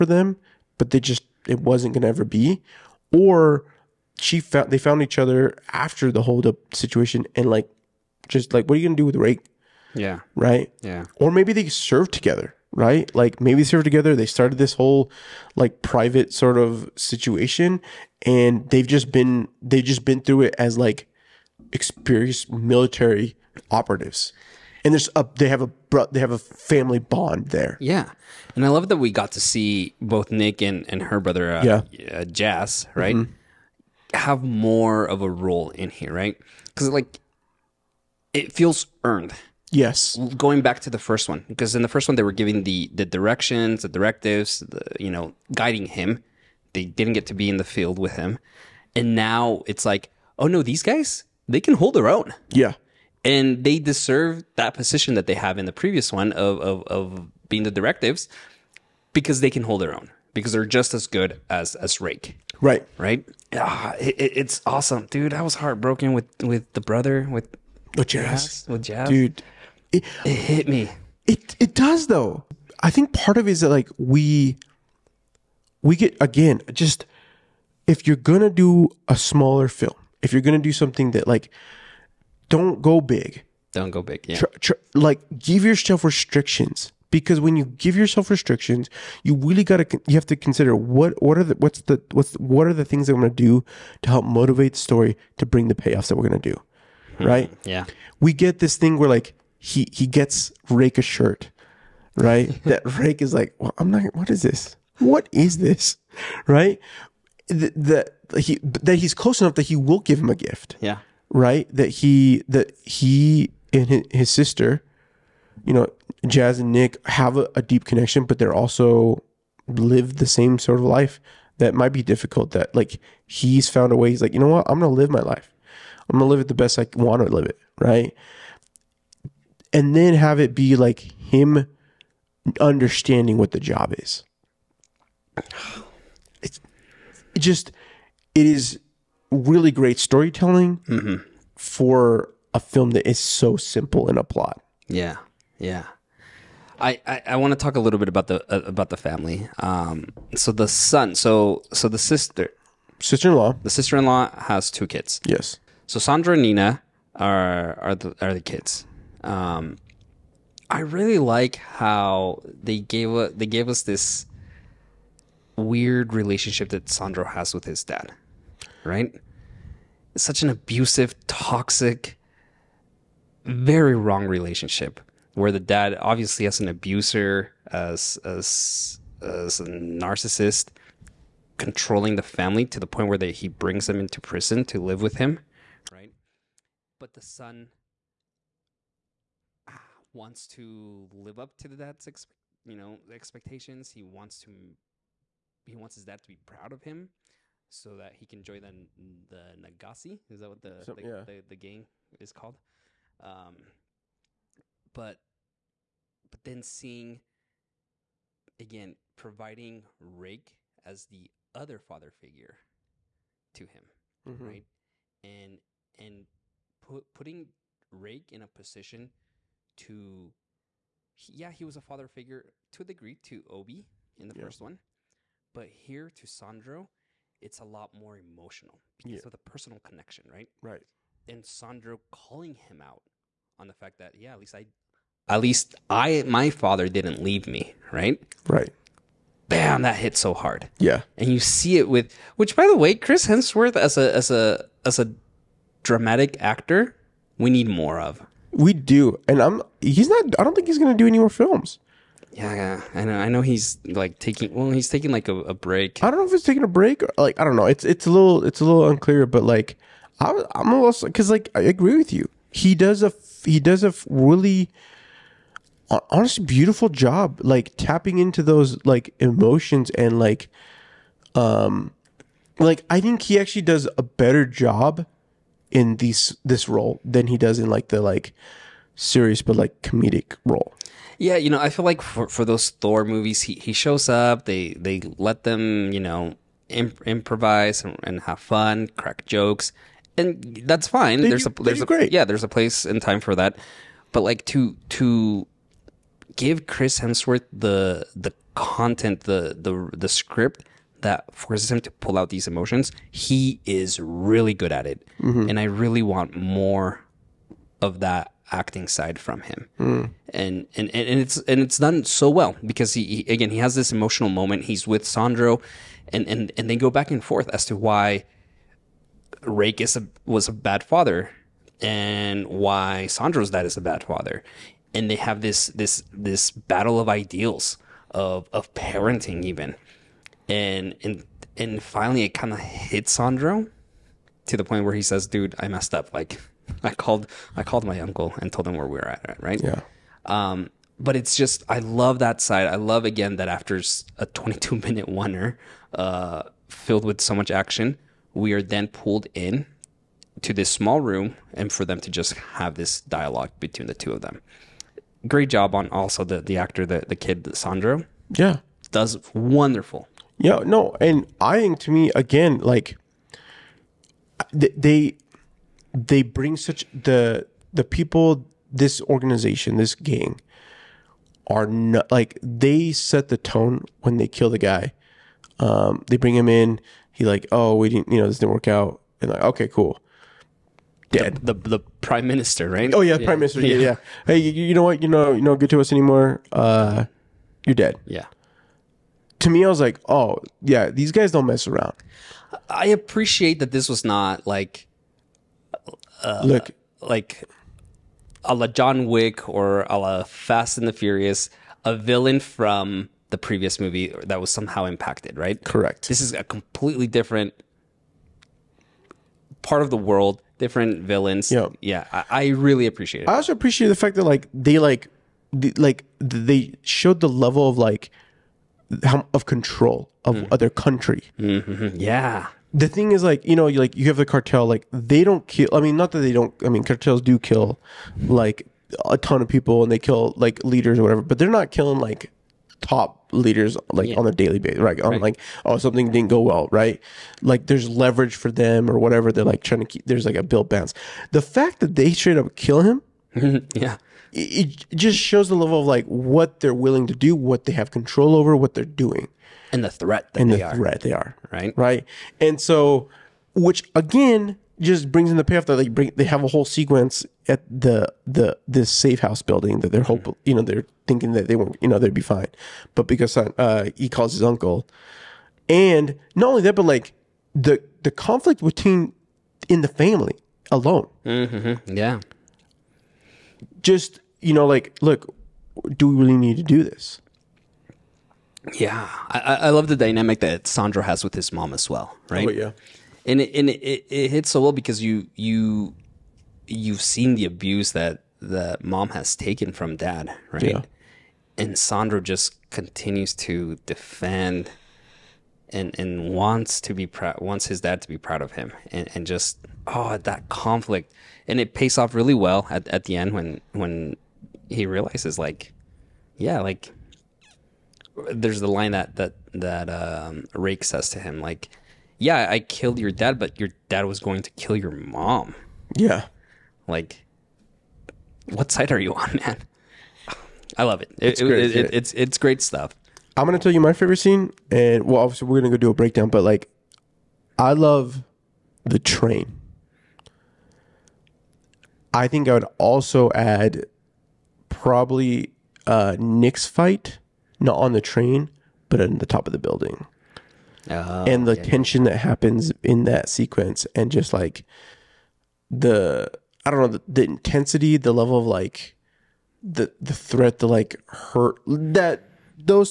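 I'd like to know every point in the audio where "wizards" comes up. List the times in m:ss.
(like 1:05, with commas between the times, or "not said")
not said.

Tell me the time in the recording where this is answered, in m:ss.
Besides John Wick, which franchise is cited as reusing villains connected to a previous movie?
6:40.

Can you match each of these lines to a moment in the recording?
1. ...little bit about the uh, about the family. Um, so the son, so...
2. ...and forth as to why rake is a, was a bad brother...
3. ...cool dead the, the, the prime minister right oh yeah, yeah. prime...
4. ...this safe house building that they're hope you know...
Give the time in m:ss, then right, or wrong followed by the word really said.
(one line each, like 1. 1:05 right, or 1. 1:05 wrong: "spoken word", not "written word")
1. 2:27 right
2. 5:17 wrong: "father", not "brother"
3. 6:19 right
4. 7:38 right.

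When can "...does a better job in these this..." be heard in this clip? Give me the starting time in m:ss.
4:33.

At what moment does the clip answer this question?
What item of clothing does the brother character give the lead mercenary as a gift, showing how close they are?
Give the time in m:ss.
1:41.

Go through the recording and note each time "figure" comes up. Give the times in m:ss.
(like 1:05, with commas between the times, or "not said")
3:32, 3:42.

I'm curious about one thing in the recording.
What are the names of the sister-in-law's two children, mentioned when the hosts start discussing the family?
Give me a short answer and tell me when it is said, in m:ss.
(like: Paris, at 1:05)
Sandro and Nina, at 2:35.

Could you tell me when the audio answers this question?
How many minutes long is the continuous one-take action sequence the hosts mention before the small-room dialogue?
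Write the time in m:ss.
5:44.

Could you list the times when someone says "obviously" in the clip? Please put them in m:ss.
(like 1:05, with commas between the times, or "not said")
2:55, 8:45.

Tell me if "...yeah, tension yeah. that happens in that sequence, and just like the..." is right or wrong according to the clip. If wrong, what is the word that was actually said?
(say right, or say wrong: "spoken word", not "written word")
right.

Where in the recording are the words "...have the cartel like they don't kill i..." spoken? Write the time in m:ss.
7:04.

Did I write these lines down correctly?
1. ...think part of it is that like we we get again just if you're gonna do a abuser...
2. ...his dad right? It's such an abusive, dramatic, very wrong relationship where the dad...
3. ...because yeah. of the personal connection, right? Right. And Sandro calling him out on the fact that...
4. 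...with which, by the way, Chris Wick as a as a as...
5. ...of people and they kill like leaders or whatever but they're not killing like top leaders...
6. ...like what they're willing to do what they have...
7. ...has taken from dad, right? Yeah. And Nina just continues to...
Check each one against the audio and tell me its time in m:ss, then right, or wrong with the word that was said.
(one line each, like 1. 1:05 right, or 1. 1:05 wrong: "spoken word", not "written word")
1. 1:12 wrong: "smaller", not "abuser"
2. 2:47 wrong: "toxic", not "dramatic"
3. 3:48 right
4. 4:01 wrong: "Hemsworth", not "Wick"
5. 7:09 right
6. 7:25 right
7. 8:09 wrong: "Sandro", not "Nina".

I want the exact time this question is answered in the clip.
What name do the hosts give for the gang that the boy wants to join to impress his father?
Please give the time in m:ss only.
3:19.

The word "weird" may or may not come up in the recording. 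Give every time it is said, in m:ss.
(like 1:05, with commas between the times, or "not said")
2:45.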